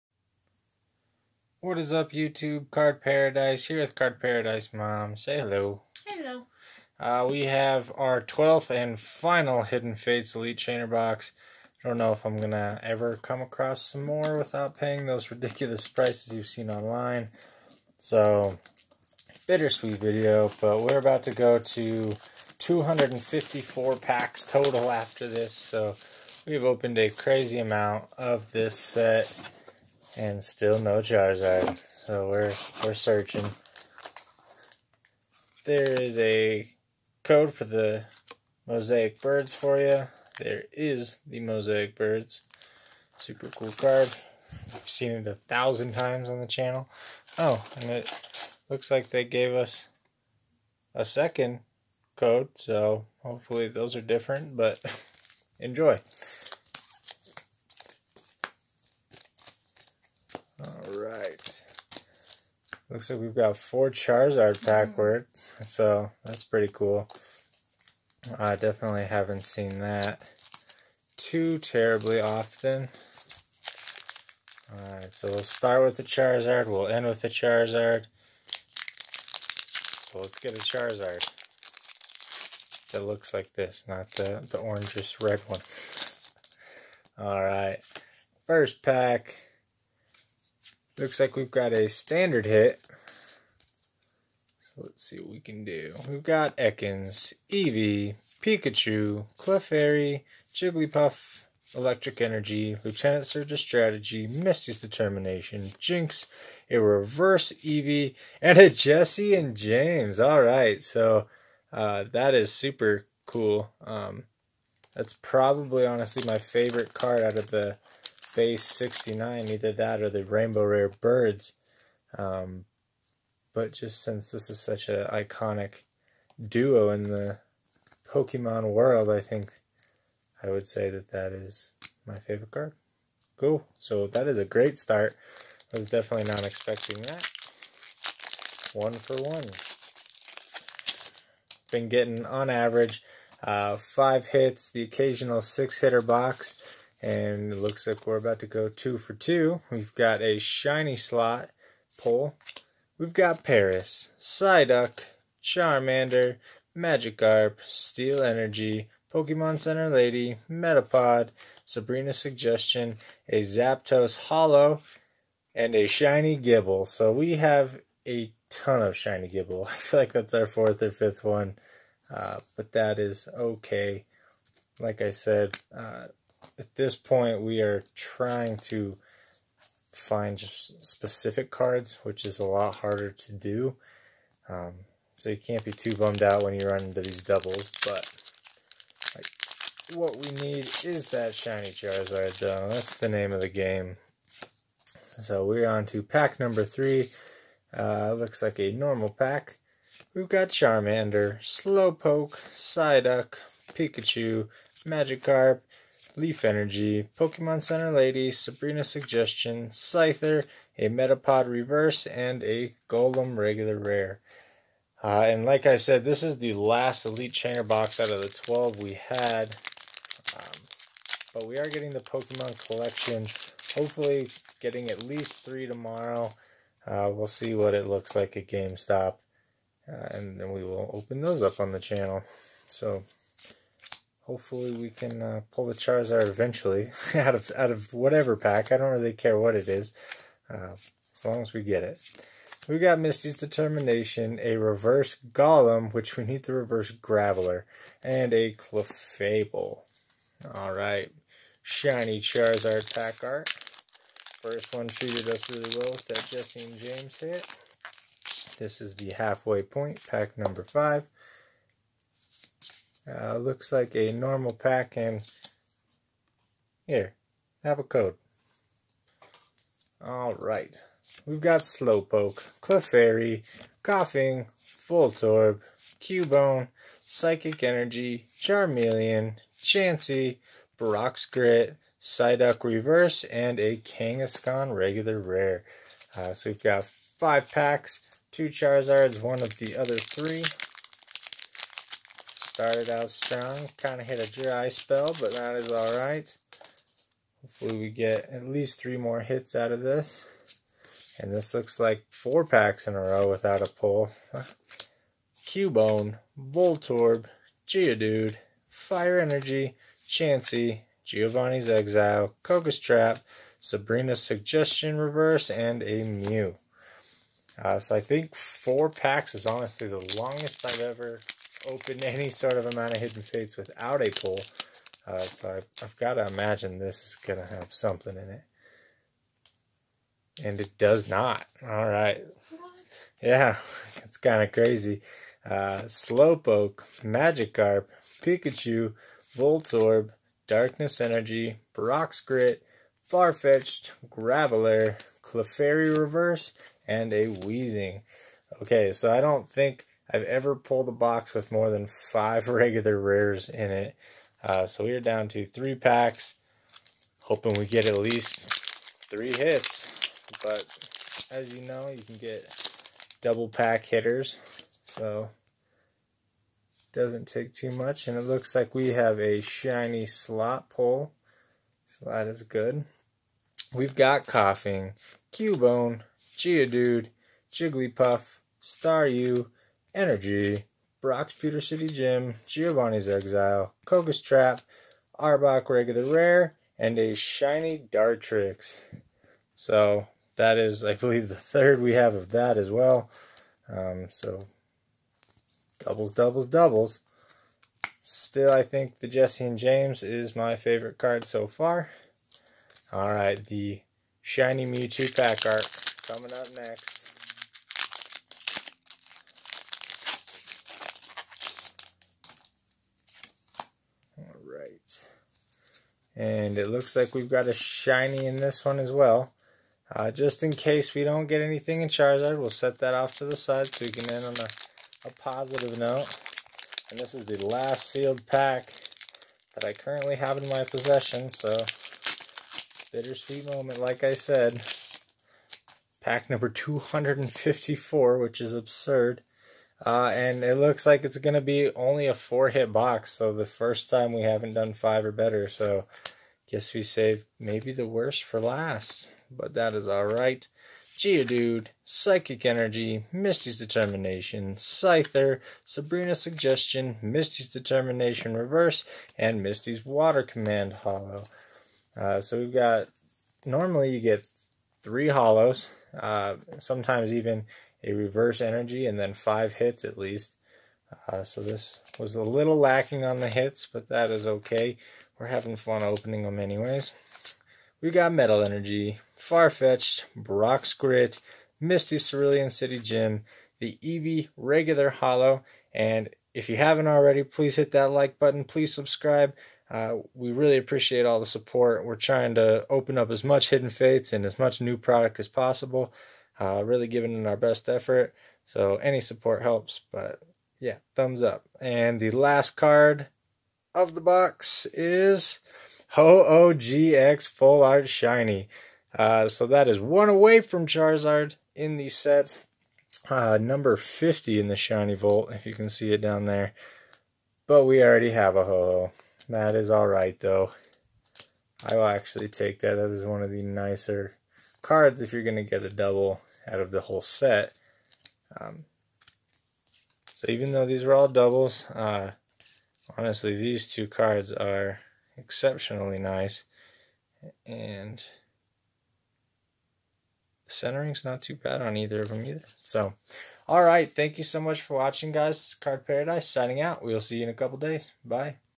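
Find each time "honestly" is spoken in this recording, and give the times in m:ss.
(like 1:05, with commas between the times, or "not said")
1:55, 5:19, 8:52.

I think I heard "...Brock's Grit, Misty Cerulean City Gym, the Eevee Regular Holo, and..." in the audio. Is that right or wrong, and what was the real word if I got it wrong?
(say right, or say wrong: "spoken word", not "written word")
right.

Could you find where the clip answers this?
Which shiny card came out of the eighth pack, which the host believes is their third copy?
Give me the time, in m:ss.
6:27.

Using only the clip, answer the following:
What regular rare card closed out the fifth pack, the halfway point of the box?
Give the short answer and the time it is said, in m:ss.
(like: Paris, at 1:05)
Kangaskhan, at 4:43.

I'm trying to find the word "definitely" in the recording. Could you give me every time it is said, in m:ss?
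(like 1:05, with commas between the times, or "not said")
1:08, 2:15.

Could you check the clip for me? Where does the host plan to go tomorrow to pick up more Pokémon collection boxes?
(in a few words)
GameStop.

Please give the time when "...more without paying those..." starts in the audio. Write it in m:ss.
0:14.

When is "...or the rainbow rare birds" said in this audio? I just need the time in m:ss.
2:00.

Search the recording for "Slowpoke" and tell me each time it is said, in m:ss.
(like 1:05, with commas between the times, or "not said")
3:21, 4:31, 5:35.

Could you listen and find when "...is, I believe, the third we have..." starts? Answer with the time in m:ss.
6:30.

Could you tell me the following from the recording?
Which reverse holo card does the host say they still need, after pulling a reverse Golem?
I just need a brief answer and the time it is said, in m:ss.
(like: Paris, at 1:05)
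Reverse Graveler, at 4:06.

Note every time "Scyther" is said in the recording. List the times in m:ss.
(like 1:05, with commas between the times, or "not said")
3:29, 7:34.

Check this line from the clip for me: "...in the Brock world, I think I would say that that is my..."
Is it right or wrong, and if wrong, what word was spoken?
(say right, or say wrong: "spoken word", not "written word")
wrong: "Pokemon", not "Brock".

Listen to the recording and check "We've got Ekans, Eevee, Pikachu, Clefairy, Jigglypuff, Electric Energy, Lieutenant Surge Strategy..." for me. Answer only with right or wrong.
right.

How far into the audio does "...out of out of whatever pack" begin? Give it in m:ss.
3:57.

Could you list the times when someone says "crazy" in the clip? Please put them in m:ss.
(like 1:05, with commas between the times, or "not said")
0:27, 5:34.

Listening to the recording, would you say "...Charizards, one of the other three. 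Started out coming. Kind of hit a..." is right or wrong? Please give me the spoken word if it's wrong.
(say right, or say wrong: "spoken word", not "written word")
wrong: "strong", not "coming".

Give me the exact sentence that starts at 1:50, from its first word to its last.
All right, so uh, that is super cool.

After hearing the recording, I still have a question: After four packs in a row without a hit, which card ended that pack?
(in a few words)
Mew.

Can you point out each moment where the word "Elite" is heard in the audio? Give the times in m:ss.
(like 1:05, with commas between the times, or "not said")
0:10, 3:37.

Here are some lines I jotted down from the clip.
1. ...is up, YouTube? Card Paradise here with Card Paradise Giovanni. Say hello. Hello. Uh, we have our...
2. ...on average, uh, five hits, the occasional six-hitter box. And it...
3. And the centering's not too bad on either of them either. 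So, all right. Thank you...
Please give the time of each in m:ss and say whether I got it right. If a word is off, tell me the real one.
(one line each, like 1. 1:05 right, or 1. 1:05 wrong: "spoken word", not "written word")
1. 0:01 wrong: "Mom", not "Giovanni"
2. 2:22 right
3. 8:57 right.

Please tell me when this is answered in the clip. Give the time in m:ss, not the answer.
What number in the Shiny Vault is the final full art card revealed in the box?
8:33.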